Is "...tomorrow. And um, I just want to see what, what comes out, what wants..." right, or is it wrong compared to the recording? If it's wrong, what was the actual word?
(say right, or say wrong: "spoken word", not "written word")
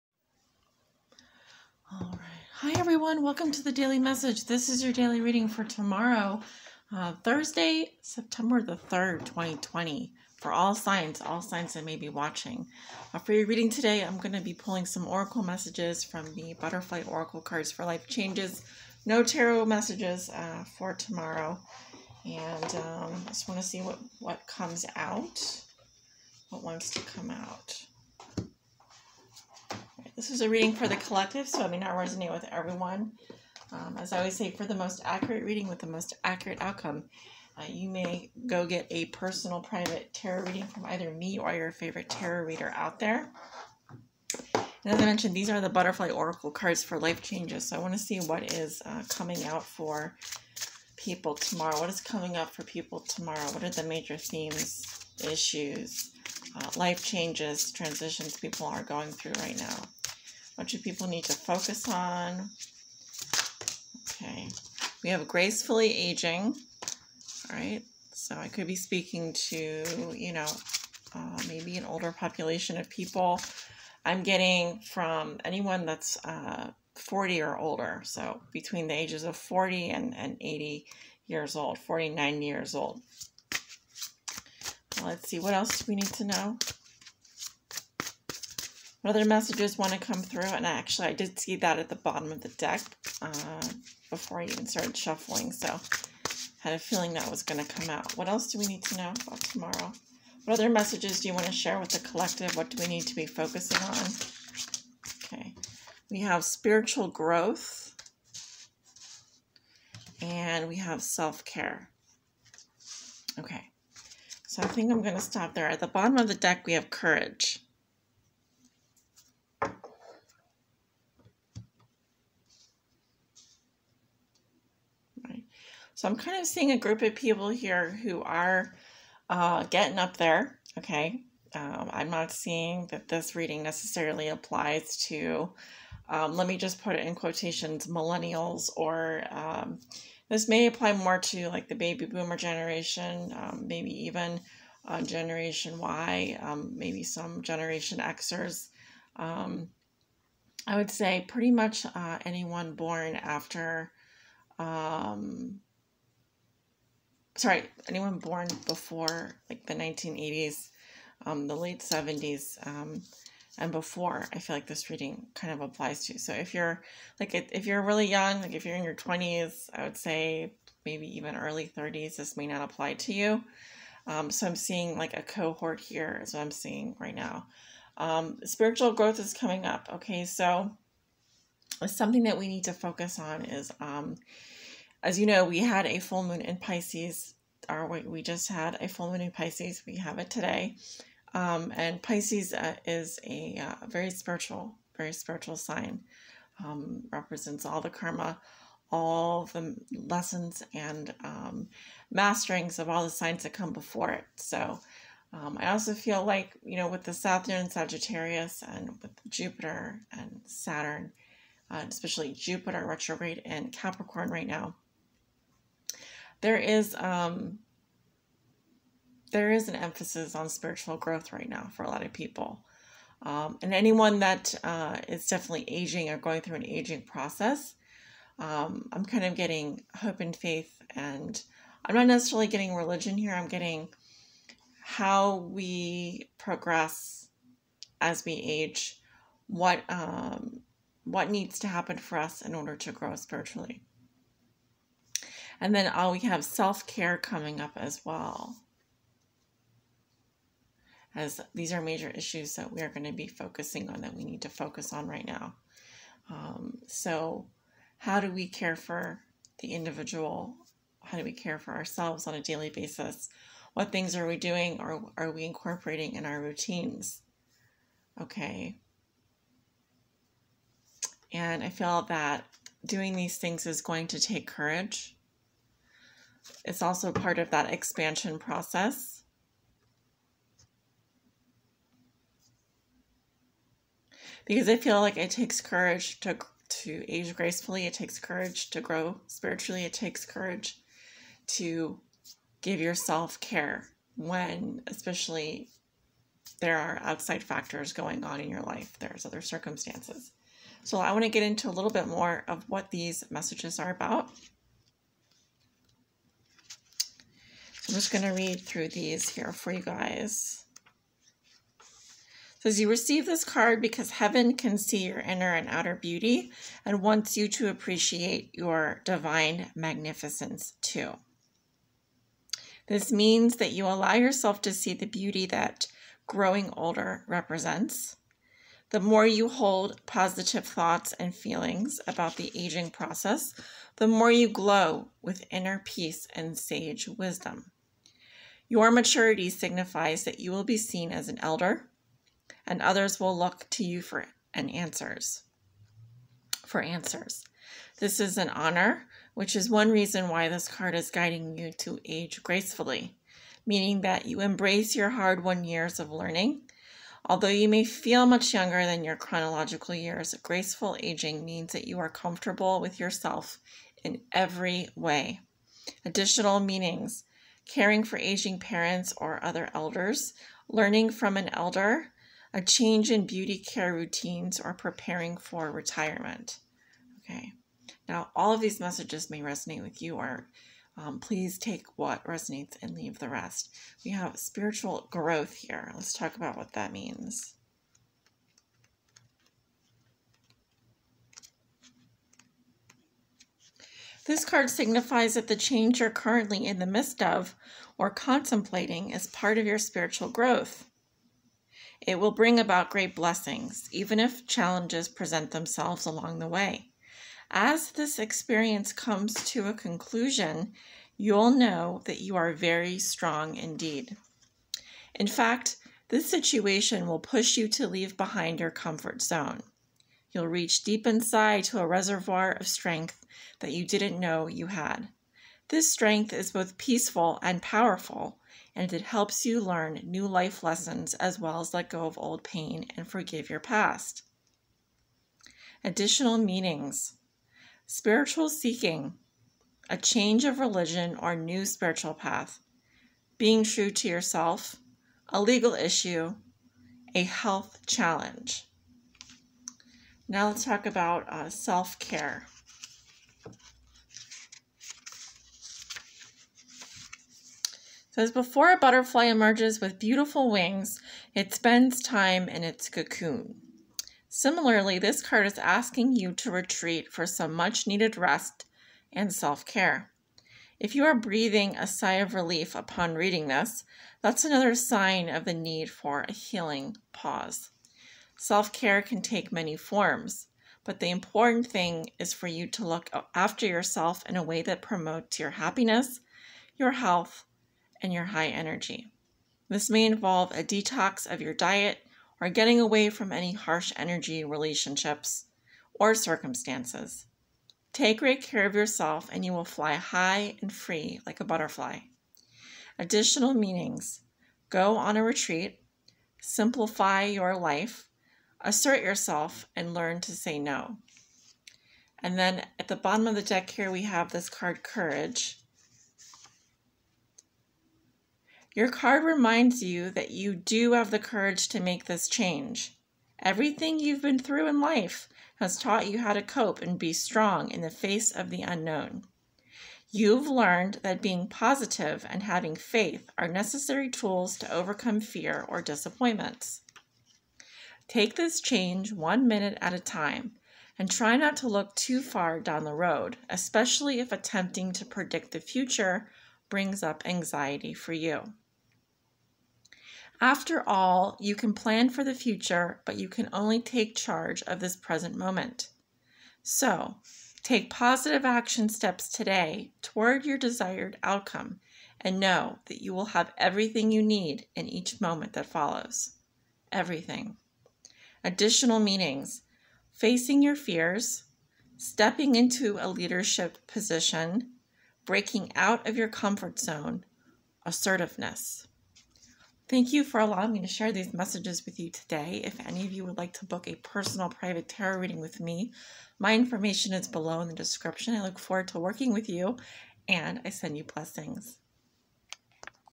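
right.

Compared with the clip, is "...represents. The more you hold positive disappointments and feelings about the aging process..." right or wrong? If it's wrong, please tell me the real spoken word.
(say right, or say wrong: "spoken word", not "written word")
wrong: "thoughts", not "disappointments".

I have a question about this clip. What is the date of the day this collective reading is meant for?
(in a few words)
September 3, 2020.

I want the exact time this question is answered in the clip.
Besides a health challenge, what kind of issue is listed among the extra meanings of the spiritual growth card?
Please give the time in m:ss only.
7:25.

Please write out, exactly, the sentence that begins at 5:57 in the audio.
Although you may feel much younger than your chronological years, graceful aging means that you are comfortable with yourself in every way.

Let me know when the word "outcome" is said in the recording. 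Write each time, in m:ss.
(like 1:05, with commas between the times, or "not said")
0:36, 9:21.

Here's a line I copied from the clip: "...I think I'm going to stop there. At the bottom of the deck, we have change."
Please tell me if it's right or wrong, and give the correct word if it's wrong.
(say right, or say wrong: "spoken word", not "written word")
wrong: "courage", not "change".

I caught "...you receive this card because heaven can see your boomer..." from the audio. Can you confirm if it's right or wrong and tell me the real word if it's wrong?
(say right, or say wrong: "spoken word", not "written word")
wrong: "inner", not "boomer".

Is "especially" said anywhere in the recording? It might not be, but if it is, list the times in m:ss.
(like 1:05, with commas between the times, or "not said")
3:31, 4:54, 9:03.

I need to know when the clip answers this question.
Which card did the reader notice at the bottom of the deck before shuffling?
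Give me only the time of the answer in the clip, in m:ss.
1:05.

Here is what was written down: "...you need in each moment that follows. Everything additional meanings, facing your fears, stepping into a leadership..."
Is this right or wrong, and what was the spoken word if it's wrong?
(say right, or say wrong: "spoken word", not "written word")
right.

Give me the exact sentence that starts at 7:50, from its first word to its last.
If you are breathing a sigh of relief upon reading this, that's another sign of the need for a healing pause.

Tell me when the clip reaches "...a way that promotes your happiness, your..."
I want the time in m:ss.
8:04.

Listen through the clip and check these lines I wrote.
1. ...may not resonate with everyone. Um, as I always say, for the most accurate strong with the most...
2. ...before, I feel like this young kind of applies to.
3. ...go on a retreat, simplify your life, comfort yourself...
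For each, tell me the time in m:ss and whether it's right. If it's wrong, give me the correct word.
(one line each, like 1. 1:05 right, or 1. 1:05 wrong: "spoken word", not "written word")
1. 0:31 wrong: "reading", not "strong"
2. 2:43 wrong: "reading", not "young"
3. 8:24 wrong: "assert", not "comfort".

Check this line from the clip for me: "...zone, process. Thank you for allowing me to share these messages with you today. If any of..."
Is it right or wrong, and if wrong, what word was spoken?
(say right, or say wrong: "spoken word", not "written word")
wrong: "assertiveness", not "process".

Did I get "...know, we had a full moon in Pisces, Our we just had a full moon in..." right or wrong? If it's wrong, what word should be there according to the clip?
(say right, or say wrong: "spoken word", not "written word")
right.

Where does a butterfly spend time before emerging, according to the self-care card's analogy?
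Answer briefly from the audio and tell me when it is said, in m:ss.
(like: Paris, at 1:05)
Its cocoon, at 7:42.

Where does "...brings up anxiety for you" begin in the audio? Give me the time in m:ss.
9:06.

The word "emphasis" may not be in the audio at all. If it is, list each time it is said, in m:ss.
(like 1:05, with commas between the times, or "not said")
3:39.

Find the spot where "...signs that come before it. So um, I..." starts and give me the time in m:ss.
3:23.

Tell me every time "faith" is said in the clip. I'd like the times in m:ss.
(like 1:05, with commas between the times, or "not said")
3:50, 8:52.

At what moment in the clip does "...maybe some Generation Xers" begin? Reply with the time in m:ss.
2:26.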